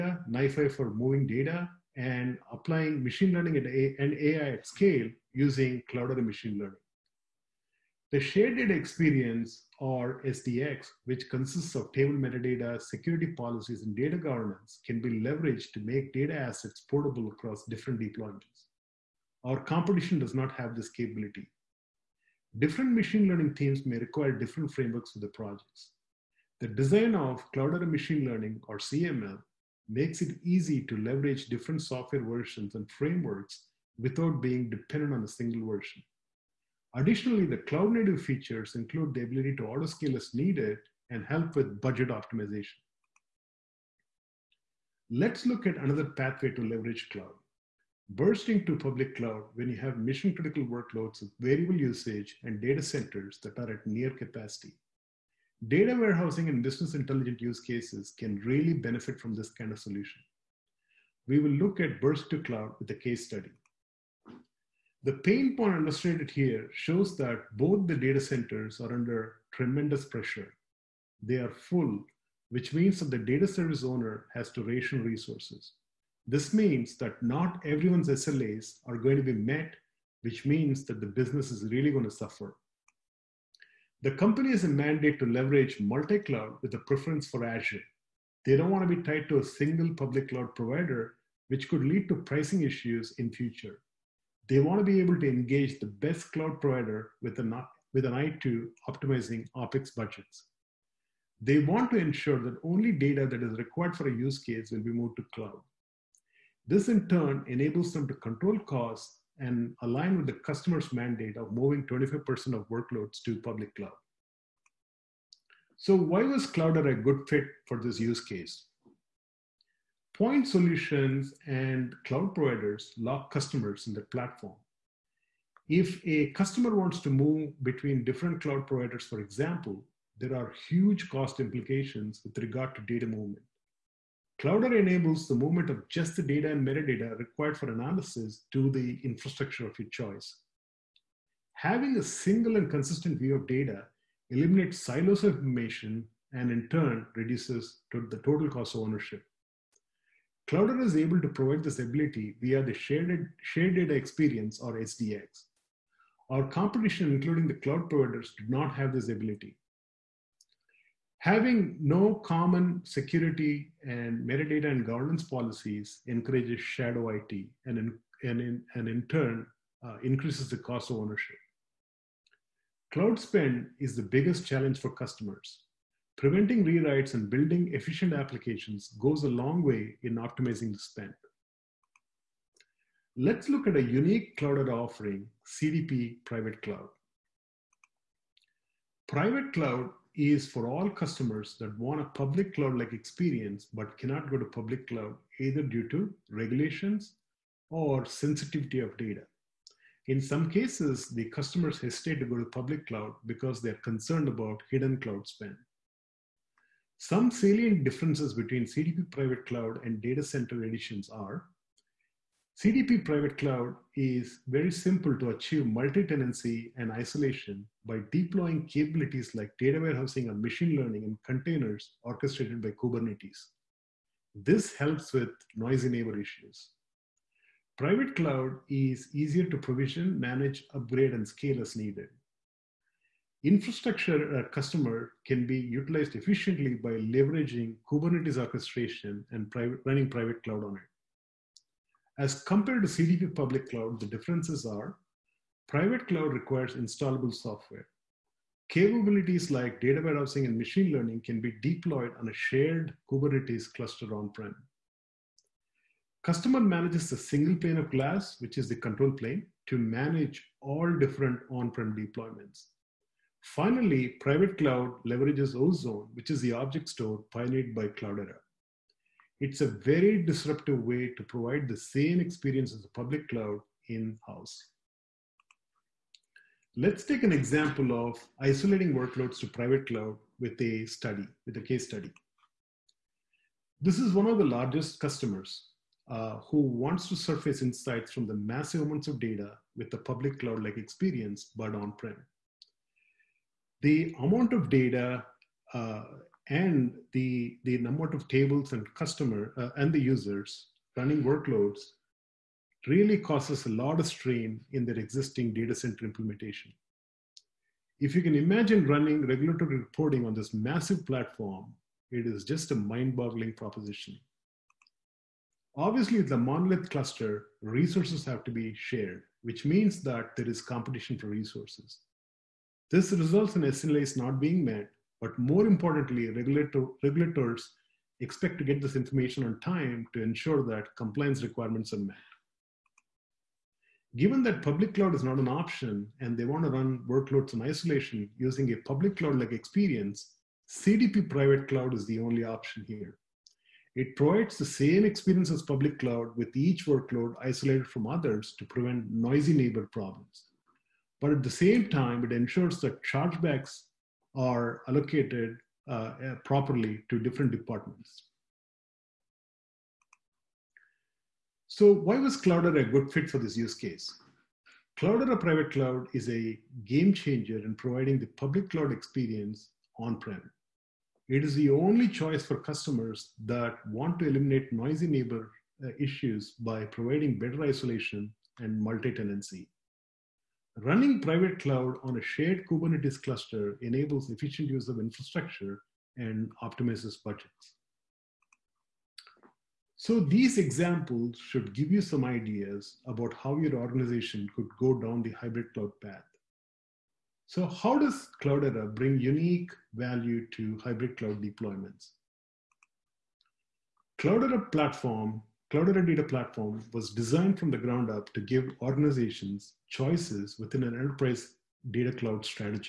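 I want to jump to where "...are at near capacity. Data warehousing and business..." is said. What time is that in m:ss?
0:53.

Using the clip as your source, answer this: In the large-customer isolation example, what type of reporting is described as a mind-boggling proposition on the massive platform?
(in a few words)
regulatory reporting.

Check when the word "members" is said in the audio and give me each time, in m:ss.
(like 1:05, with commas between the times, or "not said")
not said.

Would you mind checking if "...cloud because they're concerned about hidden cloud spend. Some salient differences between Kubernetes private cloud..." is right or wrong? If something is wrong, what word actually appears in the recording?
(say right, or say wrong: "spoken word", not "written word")
wrong: "CDP", not "Kubernetes".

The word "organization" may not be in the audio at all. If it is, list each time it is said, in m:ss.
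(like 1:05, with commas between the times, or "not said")
6:33, 6:48.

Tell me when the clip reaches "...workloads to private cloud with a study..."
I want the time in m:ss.
4:38.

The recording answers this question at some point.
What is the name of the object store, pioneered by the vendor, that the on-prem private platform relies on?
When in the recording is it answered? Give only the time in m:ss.
4:25.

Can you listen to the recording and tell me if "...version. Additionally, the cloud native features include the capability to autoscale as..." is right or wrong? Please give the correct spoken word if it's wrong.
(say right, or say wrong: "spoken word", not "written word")
wrong: "ability", not "capability".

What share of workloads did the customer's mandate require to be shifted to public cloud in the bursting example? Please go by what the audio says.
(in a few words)
25%.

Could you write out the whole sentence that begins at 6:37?
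So how does Cloudera bring unique value to hybrid cloud deployments?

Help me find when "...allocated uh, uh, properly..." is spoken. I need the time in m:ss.
5:54.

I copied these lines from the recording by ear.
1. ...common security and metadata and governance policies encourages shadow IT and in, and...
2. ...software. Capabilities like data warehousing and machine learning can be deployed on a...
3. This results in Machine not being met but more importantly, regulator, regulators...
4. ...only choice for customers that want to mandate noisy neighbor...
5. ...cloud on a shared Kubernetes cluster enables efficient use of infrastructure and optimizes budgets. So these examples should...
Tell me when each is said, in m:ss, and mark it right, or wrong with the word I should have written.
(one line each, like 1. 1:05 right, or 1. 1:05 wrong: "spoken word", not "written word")
1. 2:42 right
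2. 4:07 right
3. 5:22 wrong: "SLAs", not "Machine"
4. 6:11 wrong: "eliminate", not "mandate"
5. 6:21 right.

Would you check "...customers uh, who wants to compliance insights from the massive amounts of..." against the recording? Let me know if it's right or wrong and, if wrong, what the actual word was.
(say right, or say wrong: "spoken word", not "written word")
wrong: "surface", not "compliance".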